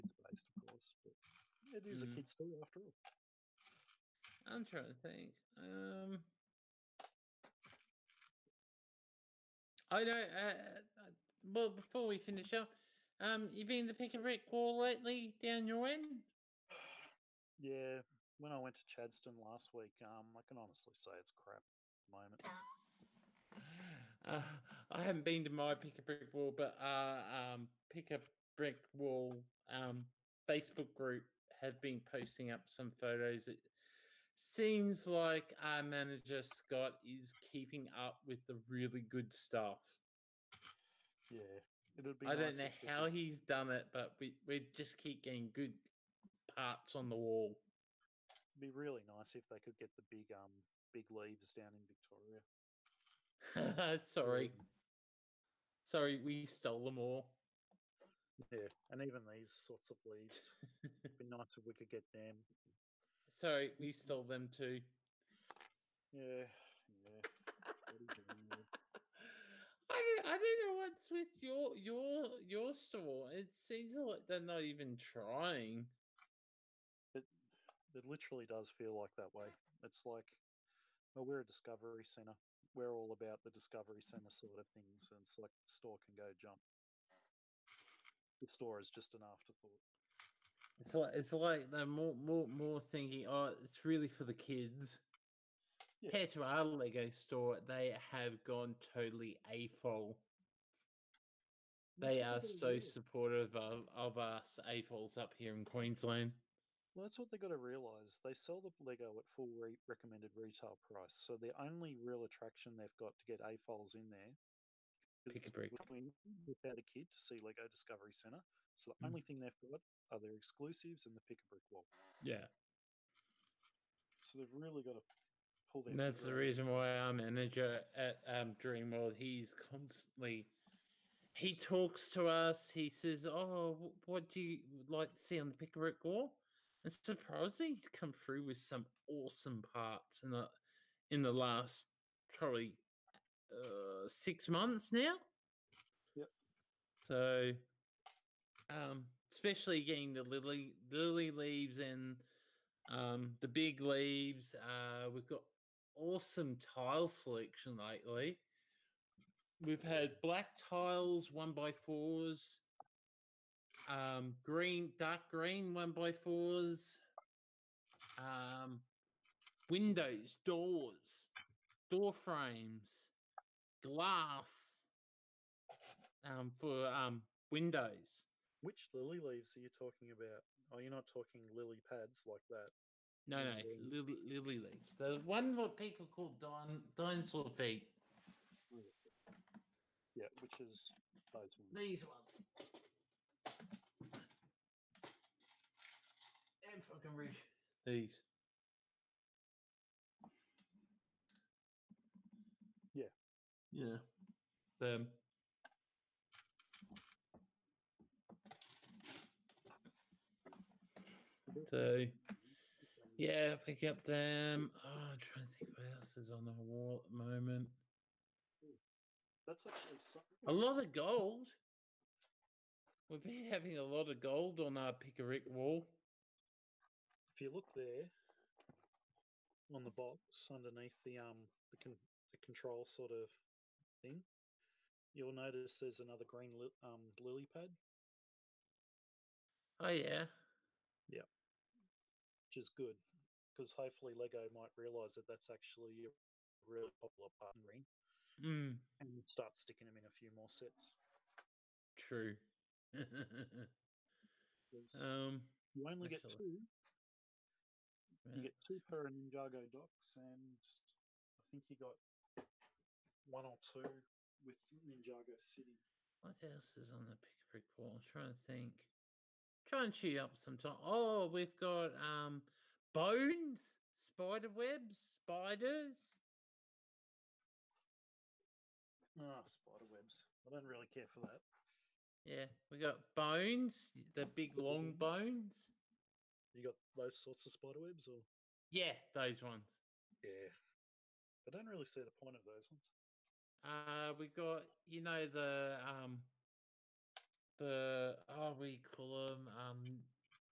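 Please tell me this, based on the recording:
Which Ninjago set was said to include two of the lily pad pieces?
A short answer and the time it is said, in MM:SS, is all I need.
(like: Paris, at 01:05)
Ninjago Docks, at 04:19.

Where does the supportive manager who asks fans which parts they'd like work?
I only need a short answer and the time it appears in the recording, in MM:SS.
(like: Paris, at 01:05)
Dreamworld, at 02:08.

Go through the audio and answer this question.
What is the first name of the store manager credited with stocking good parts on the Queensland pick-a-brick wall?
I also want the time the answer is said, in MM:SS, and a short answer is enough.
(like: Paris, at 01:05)
Scott, at 00:36.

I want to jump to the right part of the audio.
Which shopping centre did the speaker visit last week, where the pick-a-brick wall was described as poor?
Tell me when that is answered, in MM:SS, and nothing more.
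00:18.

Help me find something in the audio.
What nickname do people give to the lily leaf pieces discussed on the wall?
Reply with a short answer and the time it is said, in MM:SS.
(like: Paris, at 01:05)
dinosaur feet, at 03:06.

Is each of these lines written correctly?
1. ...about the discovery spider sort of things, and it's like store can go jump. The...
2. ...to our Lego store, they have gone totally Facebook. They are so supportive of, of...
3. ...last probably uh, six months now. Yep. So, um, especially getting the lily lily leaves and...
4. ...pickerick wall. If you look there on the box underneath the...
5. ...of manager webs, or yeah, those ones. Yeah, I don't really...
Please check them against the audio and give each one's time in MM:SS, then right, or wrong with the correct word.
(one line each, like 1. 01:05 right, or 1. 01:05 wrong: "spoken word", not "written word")
1. 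01:23 wrong: "center", not "spider"
2. 01:36 wrong: "AFOL", not "Facebook"
3. 02:21 right
4. 03:44 right
5. 04:47 wrong: "spider", not "manager".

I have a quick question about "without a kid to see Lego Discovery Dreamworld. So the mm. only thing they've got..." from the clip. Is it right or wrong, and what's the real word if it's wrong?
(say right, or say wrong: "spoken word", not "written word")
wrong: "Center", not "Dreamworld".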